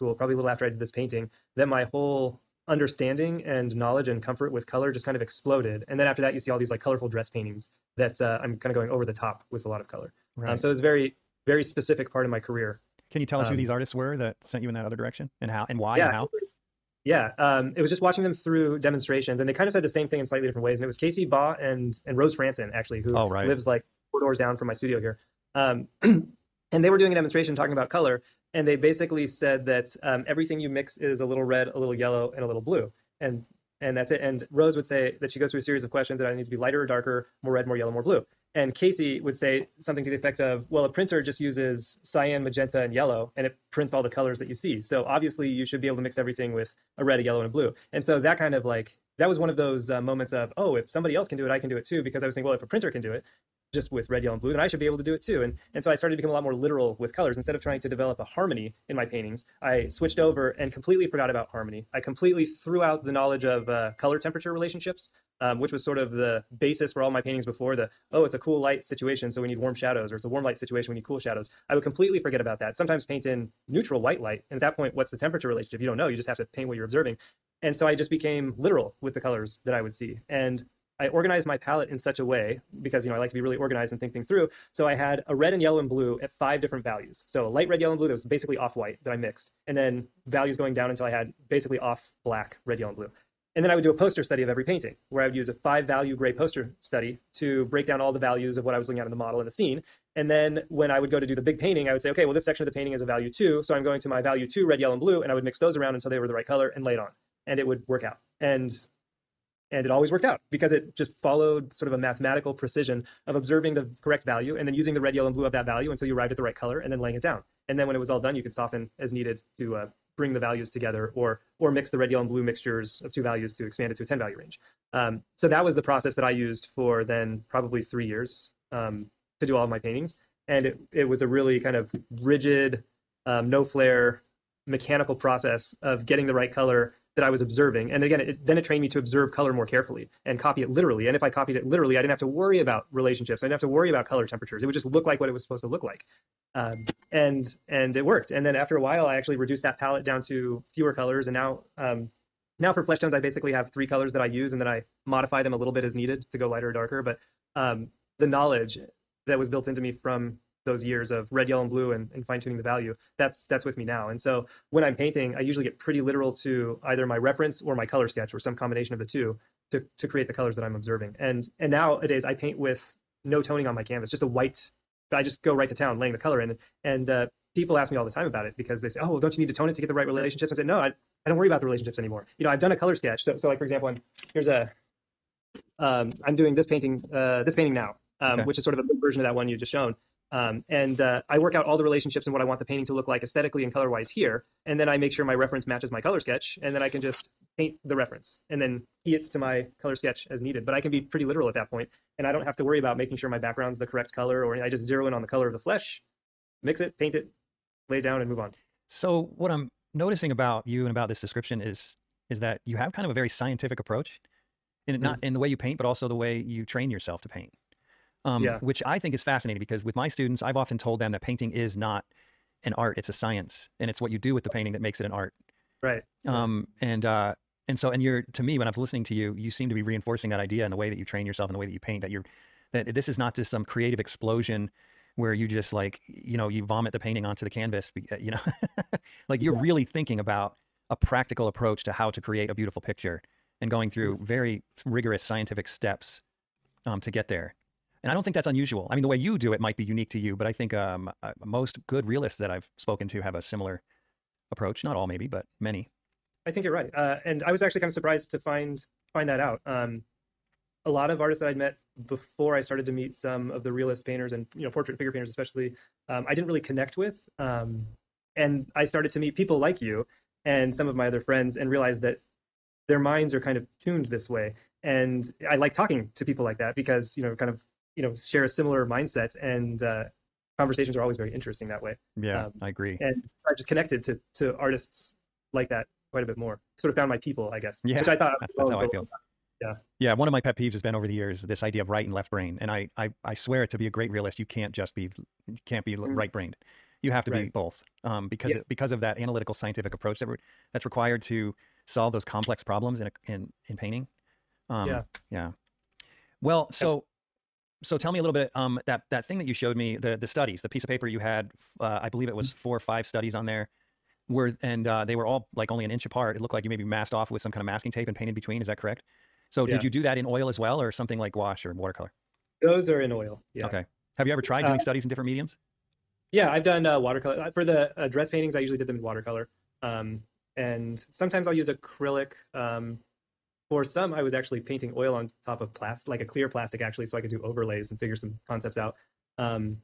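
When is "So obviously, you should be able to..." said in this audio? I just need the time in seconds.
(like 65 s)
44 s.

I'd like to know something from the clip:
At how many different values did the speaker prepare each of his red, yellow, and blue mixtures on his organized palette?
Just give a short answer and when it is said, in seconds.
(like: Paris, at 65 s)
5, at 86 s.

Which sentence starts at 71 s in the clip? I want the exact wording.
I would completely forget about that.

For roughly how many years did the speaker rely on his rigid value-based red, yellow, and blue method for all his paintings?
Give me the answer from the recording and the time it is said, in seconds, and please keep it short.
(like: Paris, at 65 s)
3, at 127 s.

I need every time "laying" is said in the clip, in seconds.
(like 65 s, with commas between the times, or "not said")
116 s, 175 s.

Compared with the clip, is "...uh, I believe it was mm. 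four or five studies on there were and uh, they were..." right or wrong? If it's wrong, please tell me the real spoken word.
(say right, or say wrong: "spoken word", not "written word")
right.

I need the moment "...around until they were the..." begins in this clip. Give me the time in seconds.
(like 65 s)
105 s.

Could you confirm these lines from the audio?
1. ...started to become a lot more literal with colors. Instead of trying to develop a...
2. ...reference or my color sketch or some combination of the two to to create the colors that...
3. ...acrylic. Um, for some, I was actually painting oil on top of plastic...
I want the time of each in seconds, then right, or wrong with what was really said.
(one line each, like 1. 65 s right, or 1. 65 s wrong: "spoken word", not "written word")
1. 55 s right
2. 167 s right
3. 331 s right.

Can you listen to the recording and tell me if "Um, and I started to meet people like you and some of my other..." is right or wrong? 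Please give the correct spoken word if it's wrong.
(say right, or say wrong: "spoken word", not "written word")
right.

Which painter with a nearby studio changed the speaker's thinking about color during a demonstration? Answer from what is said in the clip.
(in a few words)
Rose Franson.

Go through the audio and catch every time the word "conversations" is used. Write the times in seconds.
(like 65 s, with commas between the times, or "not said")
280 s.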